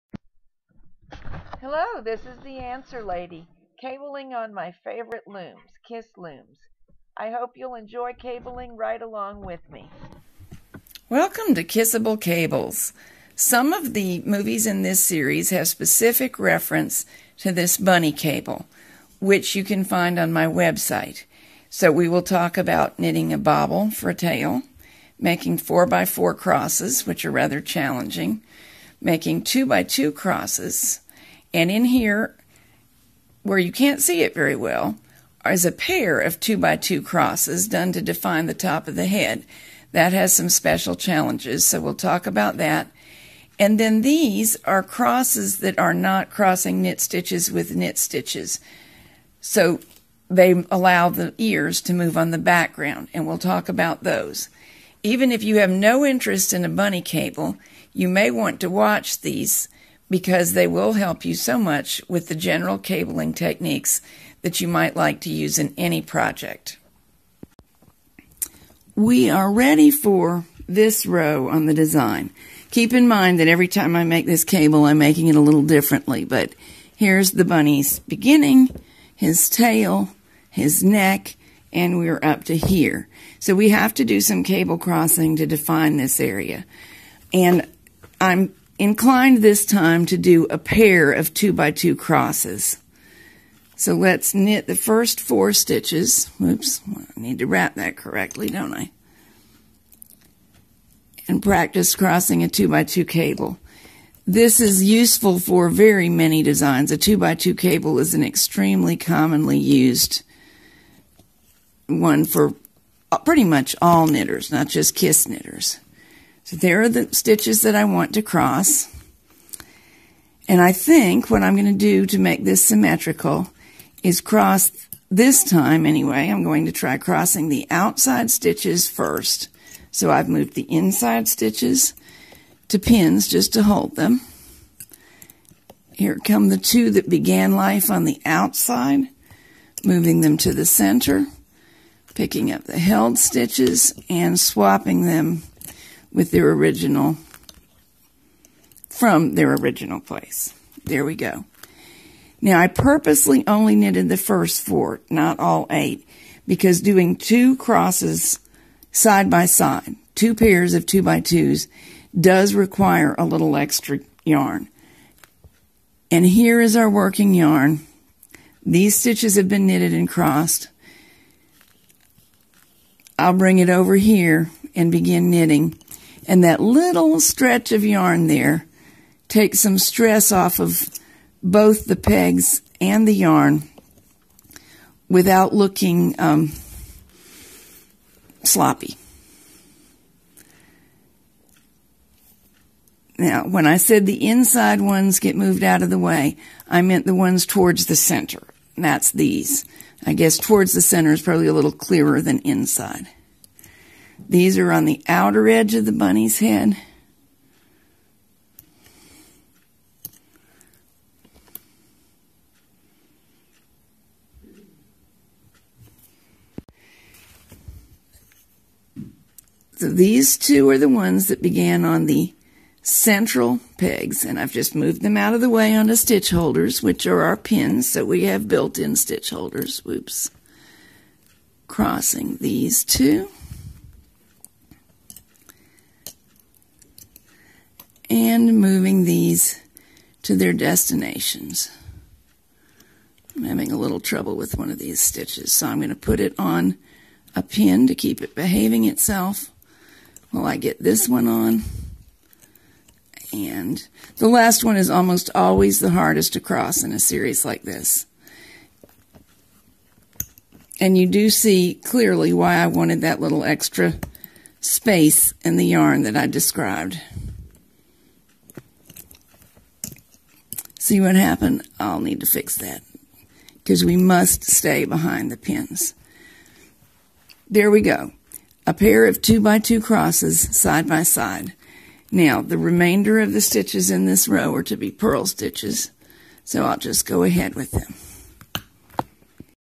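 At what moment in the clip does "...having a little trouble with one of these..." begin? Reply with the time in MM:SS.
04:03.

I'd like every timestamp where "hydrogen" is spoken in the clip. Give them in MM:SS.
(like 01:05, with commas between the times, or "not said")
not said.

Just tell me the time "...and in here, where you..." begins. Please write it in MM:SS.
00:31.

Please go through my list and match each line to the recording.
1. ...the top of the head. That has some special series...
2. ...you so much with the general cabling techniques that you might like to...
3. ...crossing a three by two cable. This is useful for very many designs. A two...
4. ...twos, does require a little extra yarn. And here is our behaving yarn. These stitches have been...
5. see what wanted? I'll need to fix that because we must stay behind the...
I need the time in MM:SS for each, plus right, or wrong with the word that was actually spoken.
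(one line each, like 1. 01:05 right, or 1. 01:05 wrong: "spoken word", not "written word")
1. 00:38 wrong: "challenges", not "series"
2. 01:01 right
3. 01:41 wrong: "two", not "three"
4. 02:41 wrong: "working", not "behaving"
5. 04:30 wrong: "happened", not "wanted".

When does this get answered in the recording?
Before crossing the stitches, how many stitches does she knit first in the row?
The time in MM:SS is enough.
01:34.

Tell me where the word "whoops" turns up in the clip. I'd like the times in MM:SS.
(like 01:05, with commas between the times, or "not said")
01:36, 03:49.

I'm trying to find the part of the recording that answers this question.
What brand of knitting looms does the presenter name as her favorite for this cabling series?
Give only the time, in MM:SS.
00:05.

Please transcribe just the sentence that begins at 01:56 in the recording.
So there are the stitches that I want to cross.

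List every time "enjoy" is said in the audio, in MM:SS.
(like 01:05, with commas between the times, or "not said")
00:07.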